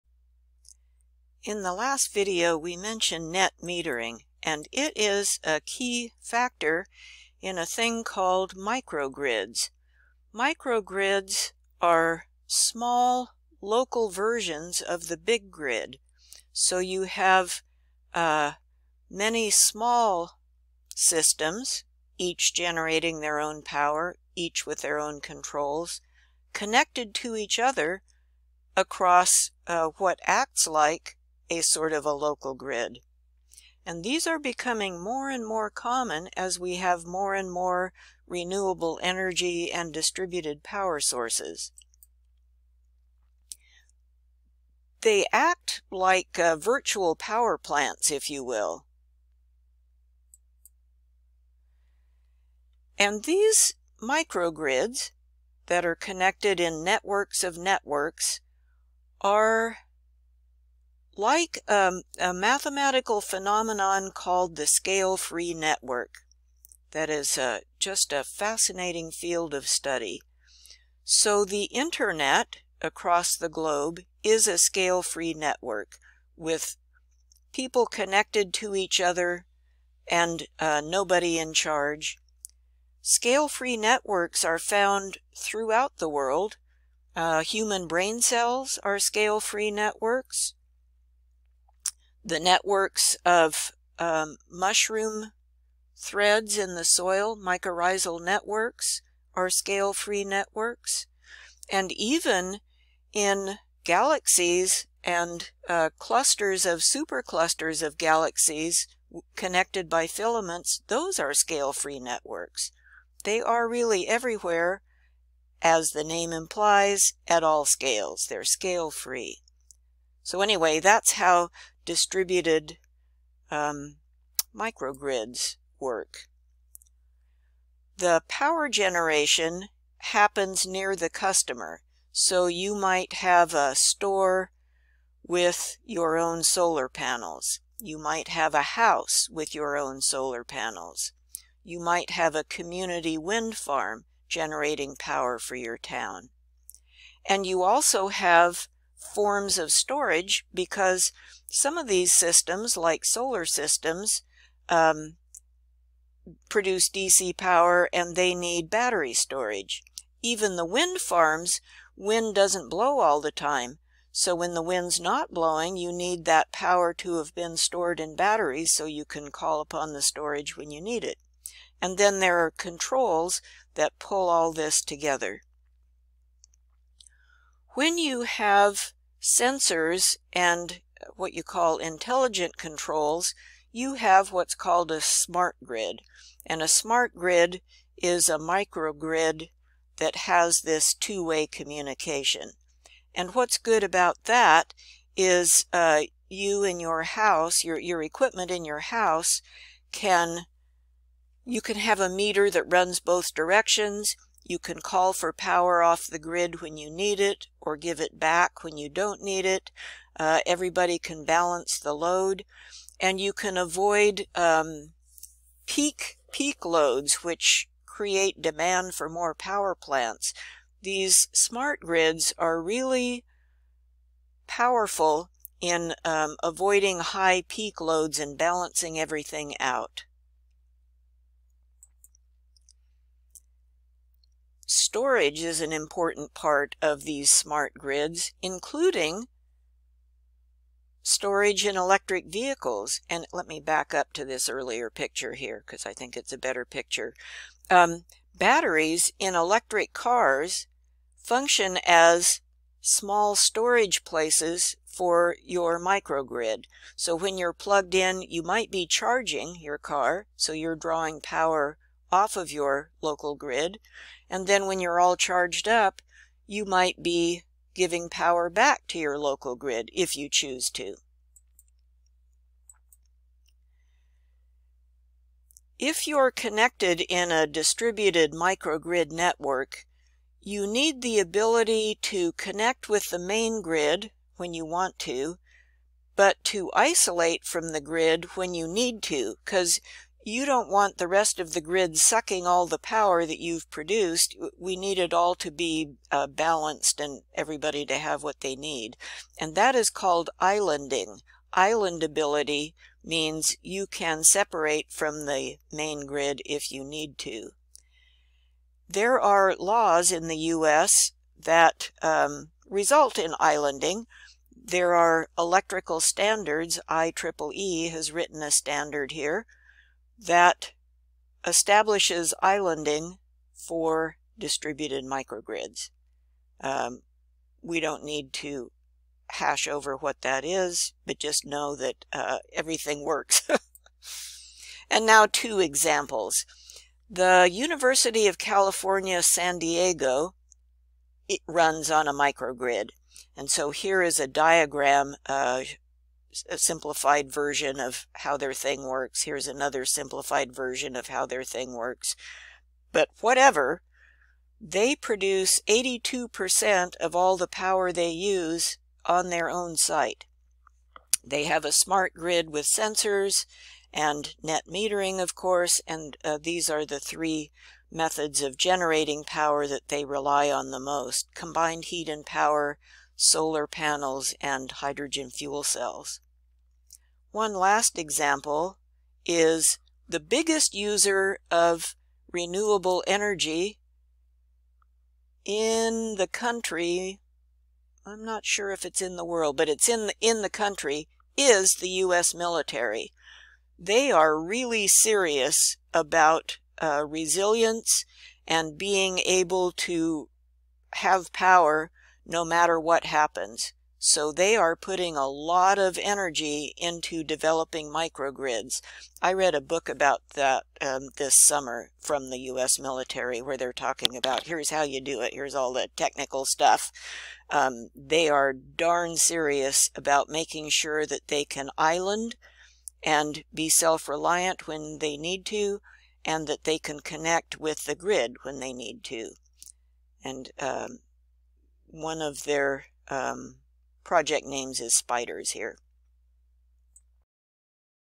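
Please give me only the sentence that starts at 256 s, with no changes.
So when you're plugged in, you might be charging your car, so you're drawing power off of your local grid.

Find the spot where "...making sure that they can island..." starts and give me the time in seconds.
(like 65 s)
420 s.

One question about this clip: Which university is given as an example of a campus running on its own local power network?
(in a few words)
University of California, San Diego.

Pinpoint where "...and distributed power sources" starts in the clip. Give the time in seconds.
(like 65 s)
39 s.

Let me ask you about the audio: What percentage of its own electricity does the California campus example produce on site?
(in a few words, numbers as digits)
82%.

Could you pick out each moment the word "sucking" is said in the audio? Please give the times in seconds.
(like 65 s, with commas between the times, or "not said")
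291 s.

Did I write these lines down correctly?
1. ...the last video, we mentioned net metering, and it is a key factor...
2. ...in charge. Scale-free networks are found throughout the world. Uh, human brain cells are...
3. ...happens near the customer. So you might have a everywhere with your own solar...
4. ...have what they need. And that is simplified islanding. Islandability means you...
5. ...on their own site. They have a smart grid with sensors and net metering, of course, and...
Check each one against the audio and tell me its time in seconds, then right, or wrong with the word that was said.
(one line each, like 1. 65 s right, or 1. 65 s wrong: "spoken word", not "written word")
1. 1 s right
2. 81 s right
3. 129 s wrong: "store", not "everywhere"
4. 297 s wrong: "called", not "simplified"
5. 359 s right.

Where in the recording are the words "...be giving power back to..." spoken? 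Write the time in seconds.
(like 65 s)
267 s.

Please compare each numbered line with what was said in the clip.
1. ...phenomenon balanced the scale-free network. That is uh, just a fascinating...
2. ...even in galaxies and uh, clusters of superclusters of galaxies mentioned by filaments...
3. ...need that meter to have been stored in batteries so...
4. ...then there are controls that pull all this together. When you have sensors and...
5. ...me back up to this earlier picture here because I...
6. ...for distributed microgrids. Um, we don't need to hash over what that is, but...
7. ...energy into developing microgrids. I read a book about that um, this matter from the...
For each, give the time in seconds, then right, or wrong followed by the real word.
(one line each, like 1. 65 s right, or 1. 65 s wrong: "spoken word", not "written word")
1. 63 s wrong: "called", not "balanced"
2. 101 s wrong: "connected", not "mentioned"
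3. 165 s wrong: "power", not "meter"
4. 171 s right
5. 243 s right
6. 323 s right
7. 406 s wrong: "summer", not "matter".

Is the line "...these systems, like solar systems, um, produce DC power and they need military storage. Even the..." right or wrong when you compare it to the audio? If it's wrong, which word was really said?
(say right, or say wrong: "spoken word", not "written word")
wrong: "battery", not "military".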